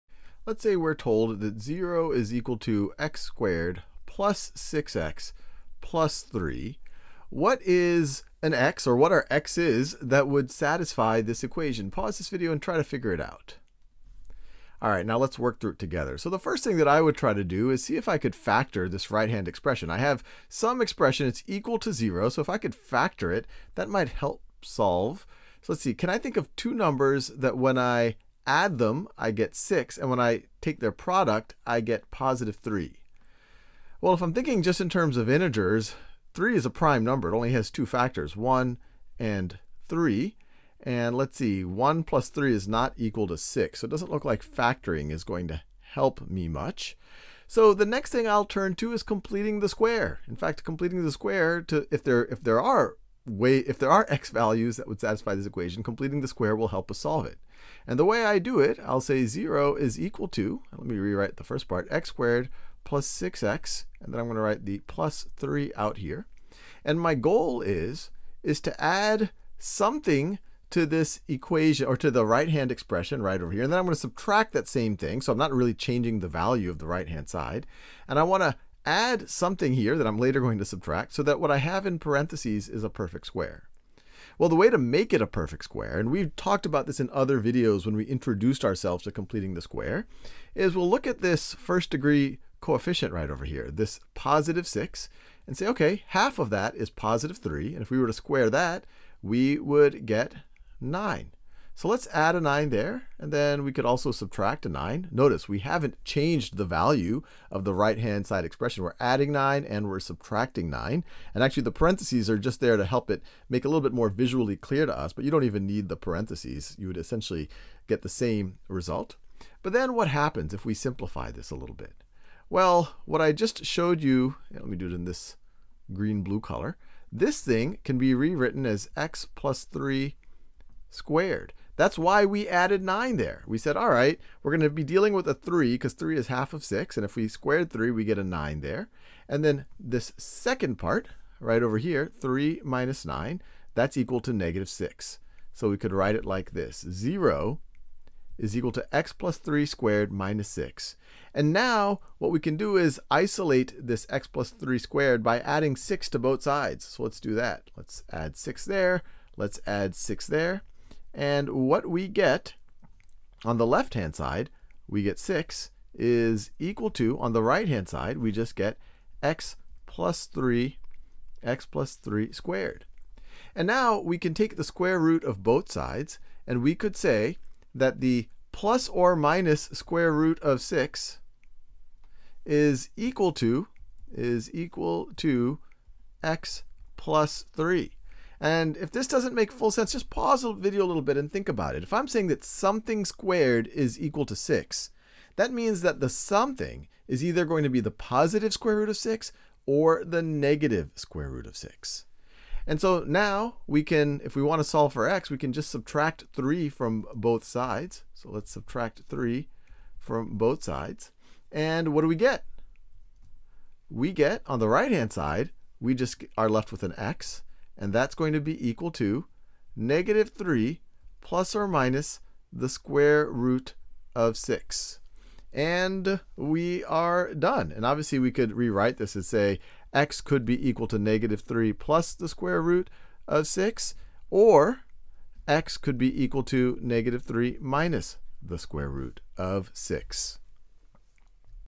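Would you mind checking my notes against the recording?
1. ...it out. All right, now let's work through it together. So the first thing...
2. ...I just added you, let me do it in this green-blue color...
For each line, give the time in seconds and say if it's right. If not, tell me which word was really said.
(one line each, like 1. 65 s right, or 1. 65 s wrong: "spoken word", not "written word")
1. 13 s right
2. 123 s wrong: "showed", not "added".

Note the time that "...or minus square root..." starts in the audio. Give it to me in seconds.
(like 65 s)
178 s.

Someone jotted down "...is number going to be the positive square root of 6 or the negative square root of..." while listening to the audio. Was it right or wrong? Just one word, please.
wrong.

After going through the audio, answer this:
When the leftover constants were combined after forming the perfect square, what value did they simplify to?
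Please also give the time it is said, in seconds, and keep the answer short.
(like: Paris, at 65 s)
-6, at 144 s.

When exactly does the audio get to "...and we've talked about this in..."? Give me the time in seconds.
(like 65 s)
85 s.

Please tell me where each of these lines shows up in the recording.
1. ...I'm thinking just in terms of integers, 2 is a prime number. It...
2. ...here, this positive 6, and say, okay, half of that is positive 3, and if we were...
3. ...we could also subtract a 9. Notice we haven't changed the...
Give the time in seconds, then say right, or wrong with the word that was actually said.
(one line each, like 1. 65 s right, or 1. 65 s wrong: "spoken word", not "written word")
1. 34 s wrong: "3", not "2"
2. 93 s right
3. 103 s right.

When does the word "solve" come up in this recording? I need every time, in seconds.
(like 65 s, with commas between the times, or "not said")
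24 s, 56 s, 204 s.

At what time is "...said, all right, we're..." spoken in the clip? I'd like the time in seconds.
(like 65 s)
133 s.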